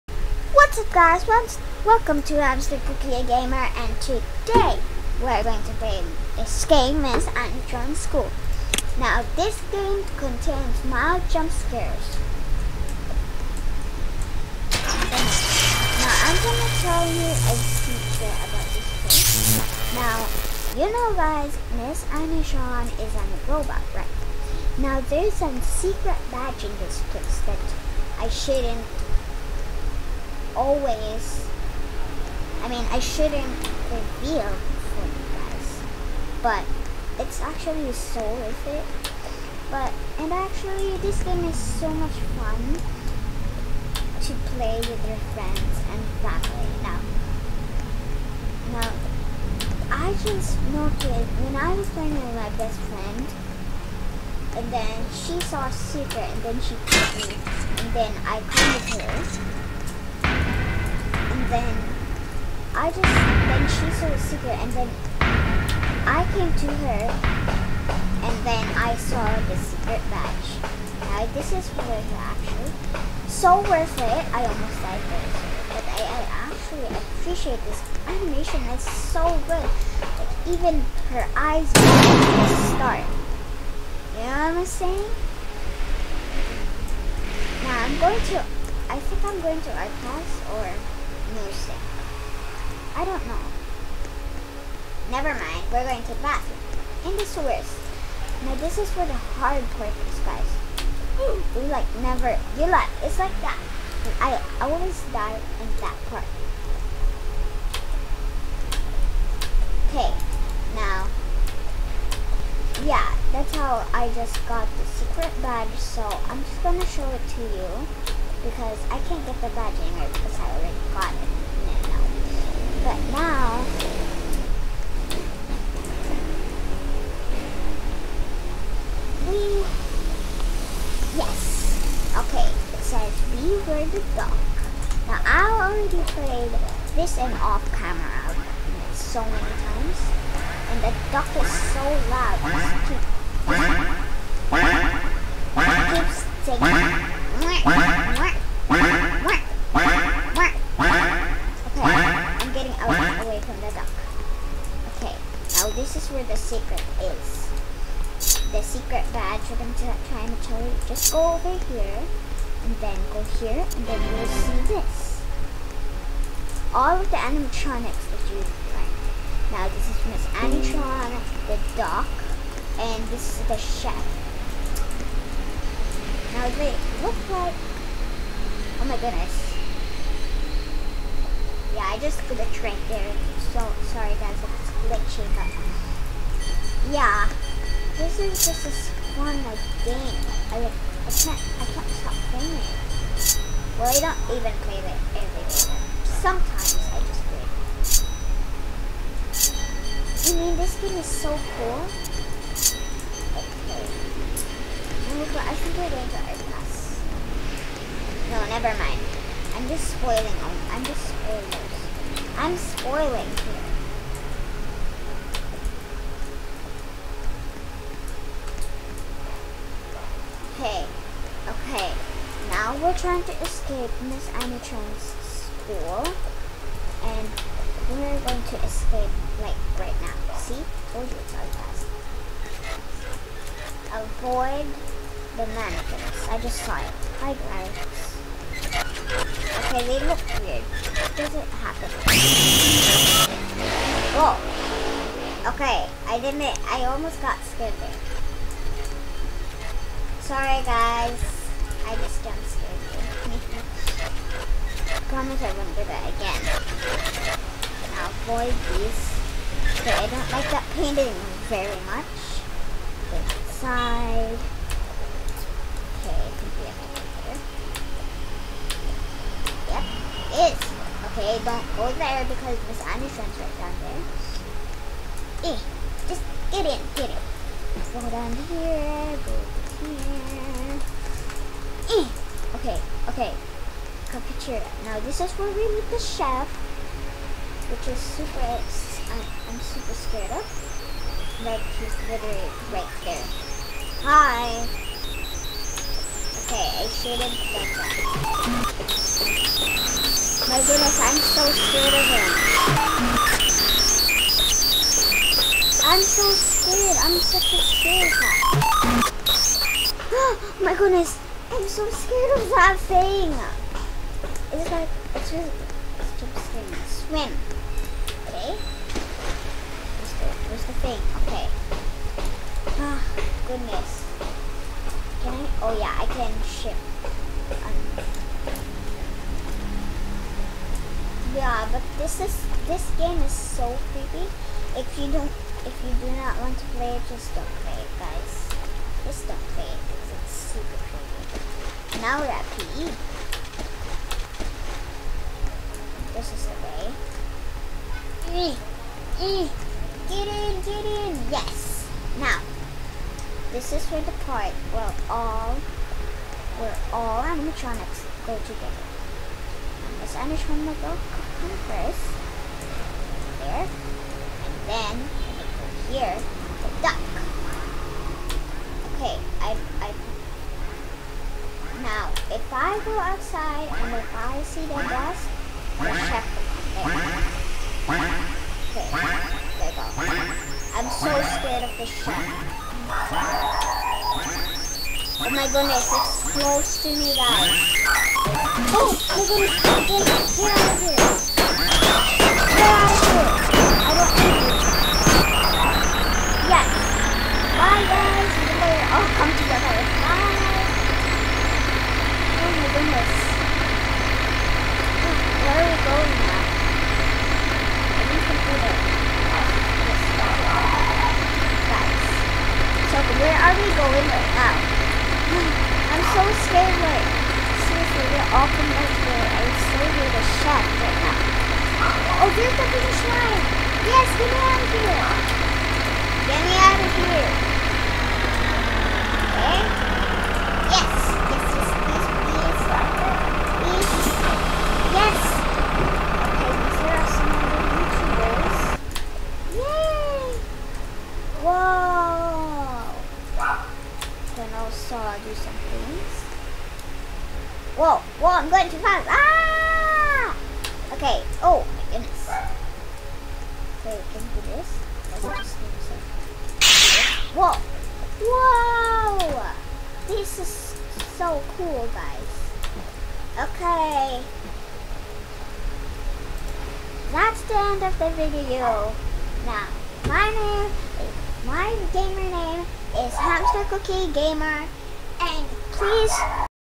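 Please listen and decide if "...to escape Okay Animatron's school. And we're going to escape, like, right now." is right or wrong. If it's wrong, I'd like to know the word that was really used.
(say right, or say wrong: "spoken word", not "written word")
wrong: "Miss", not "Okay".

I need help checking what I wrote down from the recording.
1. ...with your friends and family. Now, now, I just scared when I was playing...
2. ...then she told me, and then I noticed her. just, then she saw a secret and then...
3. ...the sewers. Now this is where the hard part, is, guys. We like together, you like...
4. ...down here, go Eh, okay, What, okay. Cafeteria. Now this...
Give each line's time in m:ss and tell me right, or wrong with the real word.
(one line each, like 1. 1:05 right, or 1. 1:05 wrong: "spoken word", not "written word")
1. 0:44 wrong: "noticed", not "scared"
2. 0:56 wrong: "called", not "noticed"
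3. 1:37 wrong: "never", not "together"
4. 4:38 wrong: "Okay", not "What".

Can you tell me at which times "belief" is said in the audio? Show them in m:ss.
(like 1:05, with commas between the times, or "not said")
not said.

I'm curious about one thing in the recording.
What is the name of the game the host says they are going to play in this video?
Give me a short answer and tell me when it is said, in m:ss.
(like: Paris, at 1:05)
Untron School, at 0:07.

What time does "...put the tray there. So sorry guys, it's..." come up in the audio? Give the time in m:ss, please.
3:02.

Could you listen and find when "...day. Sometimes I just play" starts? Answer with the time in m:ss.
3:15.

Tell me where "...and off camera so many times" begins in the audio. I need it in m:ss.
2:17.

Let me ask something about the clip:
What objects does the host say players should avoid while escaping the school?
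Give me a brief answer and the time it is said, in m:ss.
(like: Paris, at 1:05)
the mannequins, at 3:55.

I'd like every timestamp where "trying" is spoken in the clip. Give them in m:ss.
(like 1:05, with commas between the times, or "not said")
2:40, 3:42.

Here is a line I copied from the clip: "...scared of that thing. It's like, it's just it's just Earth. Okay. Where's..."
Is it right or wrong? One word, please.
wrong.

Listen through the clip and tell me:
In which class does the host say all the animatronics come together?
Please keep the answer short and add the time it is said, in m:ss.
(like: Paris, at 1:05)
PE, at 5:42.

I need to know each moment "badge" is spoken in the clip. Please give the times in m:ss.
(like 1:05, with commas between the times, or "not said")
0:26, 1:10, 1:55, 1:59, 2:39.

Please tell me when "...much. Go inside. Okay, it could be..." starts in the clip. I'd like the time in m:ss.
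4:21.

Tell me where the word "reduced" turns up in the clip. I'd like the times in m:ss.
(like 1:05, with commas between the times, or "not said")
not said.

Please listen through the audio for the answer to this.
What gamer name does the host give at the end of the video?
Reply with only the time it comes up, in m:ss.
7:53.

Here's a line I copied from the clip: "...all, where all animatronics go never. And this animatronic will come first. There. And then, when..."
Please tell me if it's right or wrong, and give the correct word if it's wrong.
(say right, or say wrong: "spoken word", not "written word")
wrong: "together", not "never".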